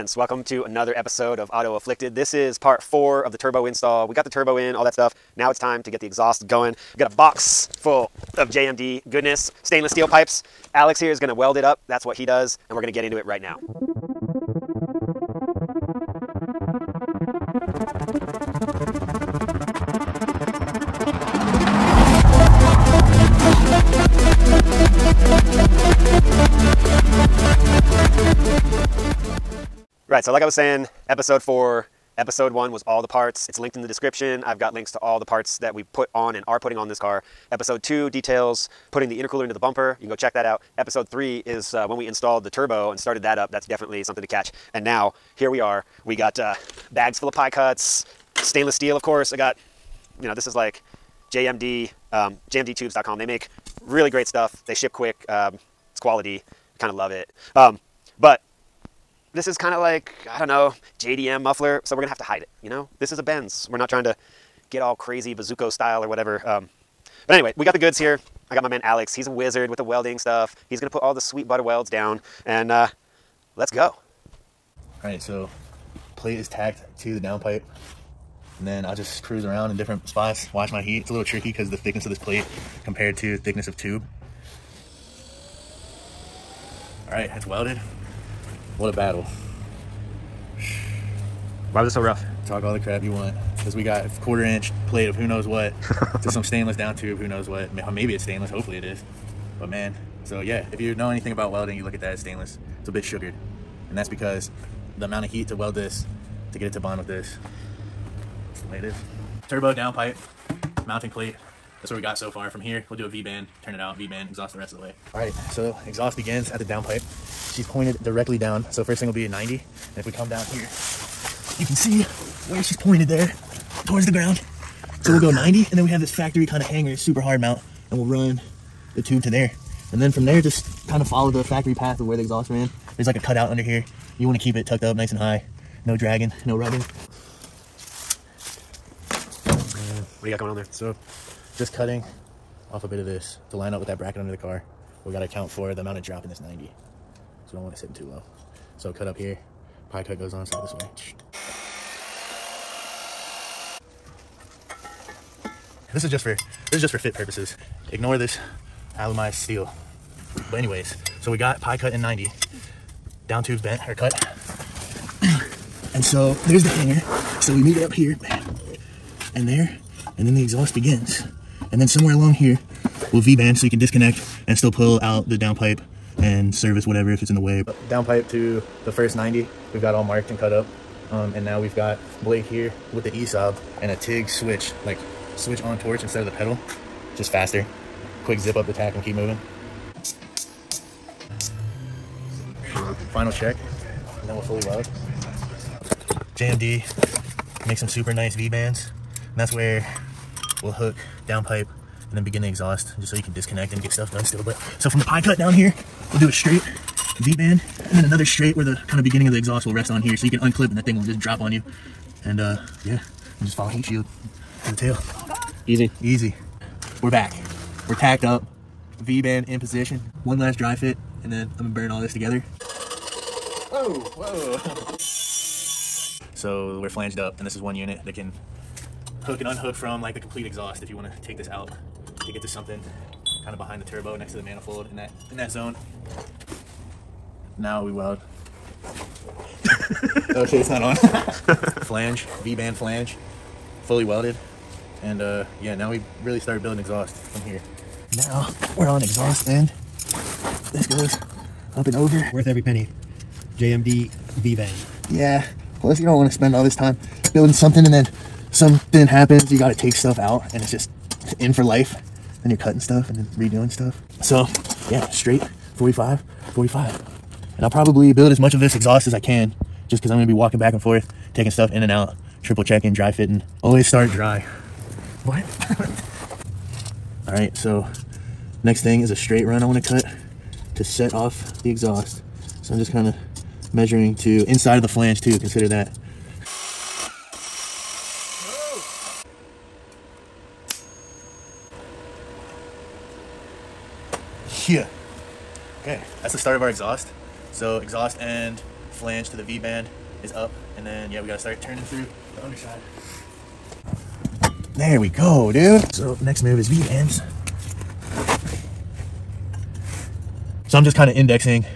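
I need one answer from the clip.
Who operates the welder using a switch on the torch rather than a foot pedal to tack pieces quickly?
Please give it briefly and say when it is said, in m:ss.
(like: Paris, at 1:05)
Blake, at 3:02.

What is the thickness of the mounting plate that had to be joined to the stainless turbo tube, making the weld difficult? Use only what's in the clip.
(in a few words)
Quarter inch.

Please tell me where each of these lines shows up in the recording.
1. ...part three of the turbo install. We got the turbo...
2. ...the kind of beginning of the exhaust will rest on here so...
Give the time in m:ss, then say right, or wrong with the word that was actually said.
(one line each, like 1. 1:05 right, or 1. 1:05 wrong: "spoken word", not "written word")
1. 0:02 wrong: "four", not "three"
2. 3:28 right.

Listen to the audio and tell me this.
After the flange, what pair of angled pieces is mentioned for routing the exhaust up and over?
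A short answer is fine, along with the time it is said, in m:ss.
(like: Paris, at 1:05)
45, 45, at 4:25.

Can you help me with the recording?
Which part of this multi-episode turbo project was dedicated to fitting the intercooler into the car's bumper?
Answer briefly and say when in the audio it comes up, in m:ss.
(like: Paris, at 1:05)
Episode 2, at 0:37.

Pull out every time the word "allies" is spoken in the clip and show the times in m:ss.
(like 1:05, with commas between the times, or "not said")
not said.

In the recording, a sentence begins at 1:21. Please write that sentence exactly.
It's a little tricky because the thickness of this plate compared to thickness of tube.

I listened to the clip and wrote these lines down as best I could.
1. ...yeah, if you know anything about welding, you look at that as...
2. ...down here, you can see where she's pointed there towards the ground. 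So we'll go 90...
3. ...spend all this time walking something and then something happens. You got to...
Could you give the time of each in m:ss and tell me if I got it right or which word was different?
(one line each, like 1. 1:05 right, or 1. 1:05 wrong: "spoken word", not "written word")
1. 1:40 right
2. 2:00 right
3. 4:16 wrong: "building", not "walking".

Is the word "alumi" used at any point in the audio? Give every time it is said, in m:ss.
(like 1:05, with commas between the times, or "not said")
2:38.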